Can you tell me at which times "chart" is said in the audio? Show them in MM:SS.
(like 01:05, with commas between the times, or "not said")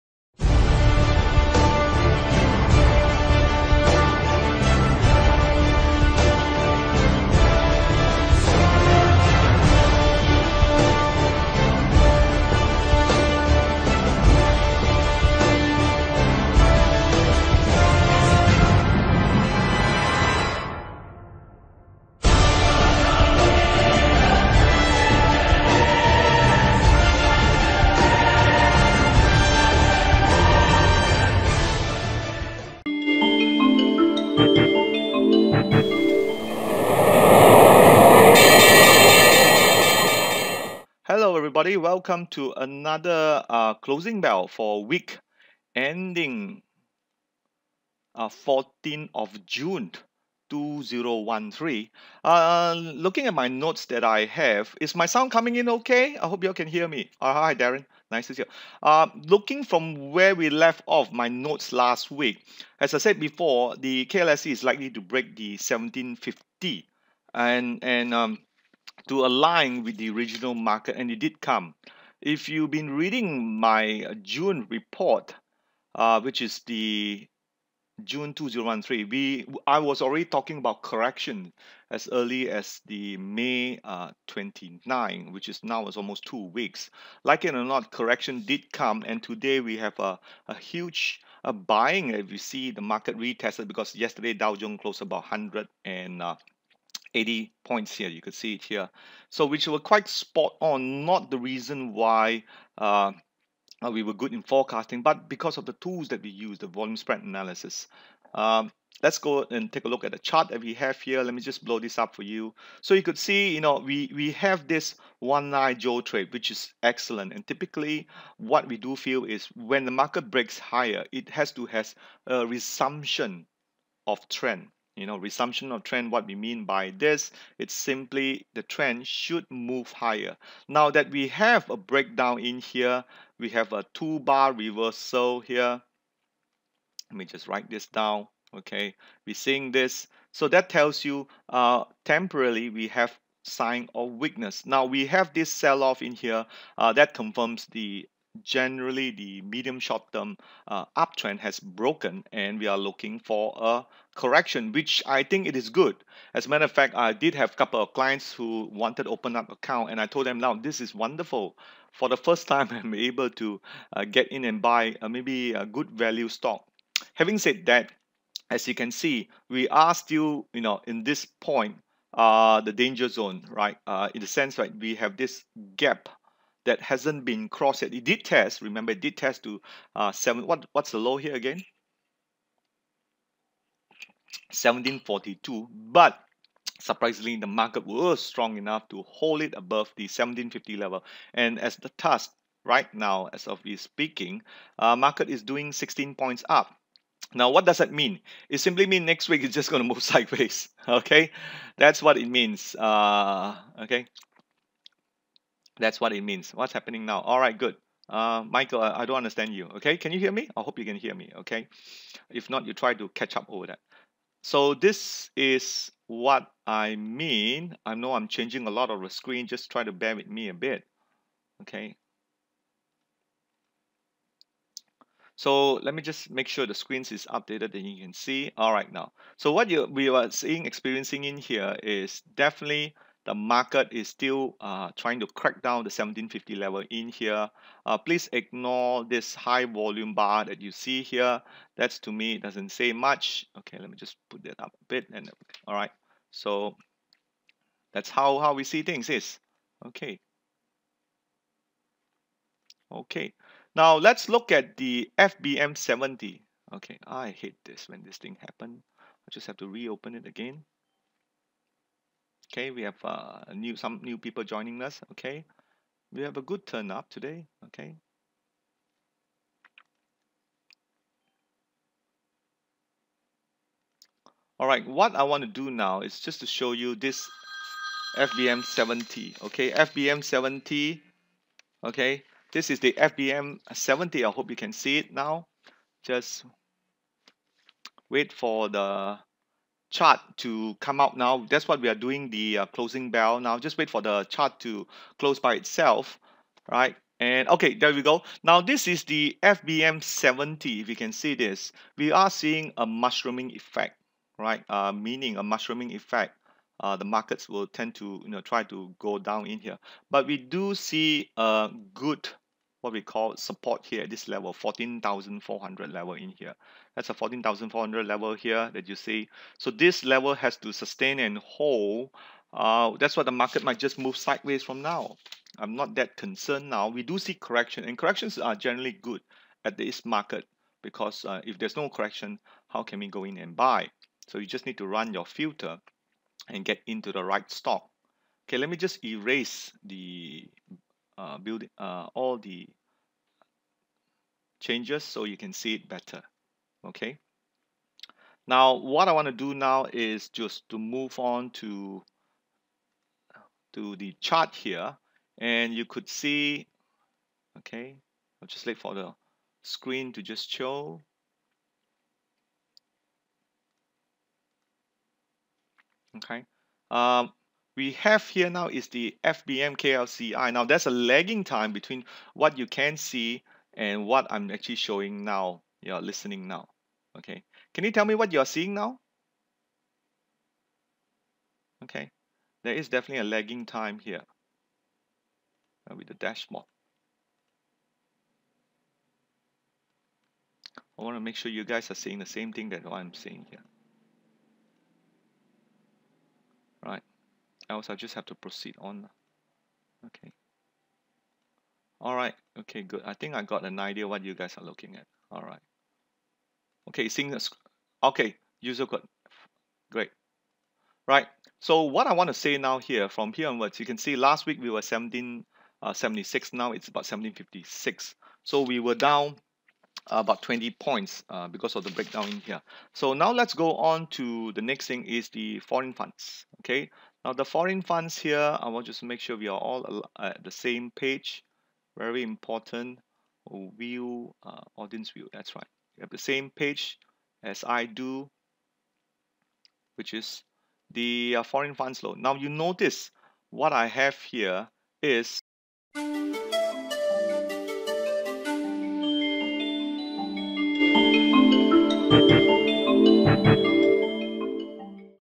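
01:50, 04:49, 04:54, 05:54.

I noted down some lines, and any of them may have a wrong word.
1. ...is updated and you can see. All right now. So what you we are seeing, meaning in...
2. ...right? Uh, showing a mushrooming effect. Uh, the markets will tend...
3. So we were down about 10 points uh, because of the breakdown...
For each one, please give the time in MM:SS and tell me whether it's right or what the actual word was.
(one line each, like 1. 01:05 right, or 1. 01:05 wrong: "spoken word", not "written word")
1. 03:47 wrong: "experiencing", not "meaning"
2. 05:04 wrong: "meaning", not "showing"
3. 06:58 wrong: "20", not "10".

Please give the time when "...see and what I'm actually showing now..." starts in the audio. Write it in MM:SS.
06:12.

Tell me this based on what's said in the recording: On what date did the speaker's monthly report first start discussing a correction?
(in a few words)
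May 29.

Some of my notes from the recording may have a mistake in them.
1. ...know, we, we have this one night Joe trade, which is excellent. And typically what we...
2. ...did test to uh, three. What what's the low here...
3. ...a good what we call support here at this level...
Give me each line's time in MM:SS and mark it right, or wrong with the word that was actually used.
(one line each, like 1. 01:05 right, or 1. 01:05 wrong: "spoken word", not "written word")
1. 01:53 right
2. 02:59 wrong: "seven", not "three"
3. 05:11 right.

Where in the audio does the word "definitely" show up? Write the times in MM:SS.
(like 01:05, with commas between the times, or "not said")
03:52, 06:22.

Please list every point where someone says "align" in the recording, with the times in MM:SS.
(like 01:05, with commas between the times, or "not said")
01:09.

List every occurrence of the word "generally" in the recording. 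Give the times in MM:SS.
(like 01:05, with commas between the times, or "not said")
02:28, 05:28.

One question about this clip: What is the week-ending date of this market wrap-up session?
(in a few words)
14th of June 2013.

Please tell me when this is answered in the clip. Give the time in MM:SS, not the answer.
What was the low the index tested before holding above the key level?
03:04.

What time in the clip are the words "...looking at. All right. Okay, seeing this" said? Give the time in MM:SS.
06:44.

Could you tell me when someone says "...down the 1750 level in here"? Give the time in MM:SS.
03:55.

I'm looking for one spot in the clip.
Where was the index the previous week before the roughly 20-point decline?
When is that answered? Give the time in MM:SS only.
06:54.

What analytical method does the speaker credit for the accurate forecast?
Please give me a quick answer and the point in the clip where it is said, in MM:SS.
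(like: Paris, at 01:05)
volume spread analysis, at 01:46.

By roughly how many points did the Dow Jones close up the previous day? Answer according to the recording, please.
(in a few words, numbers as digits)
180.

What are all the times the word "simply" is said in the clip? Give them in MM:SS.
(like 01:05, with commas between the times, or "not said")
02:07, 03:18.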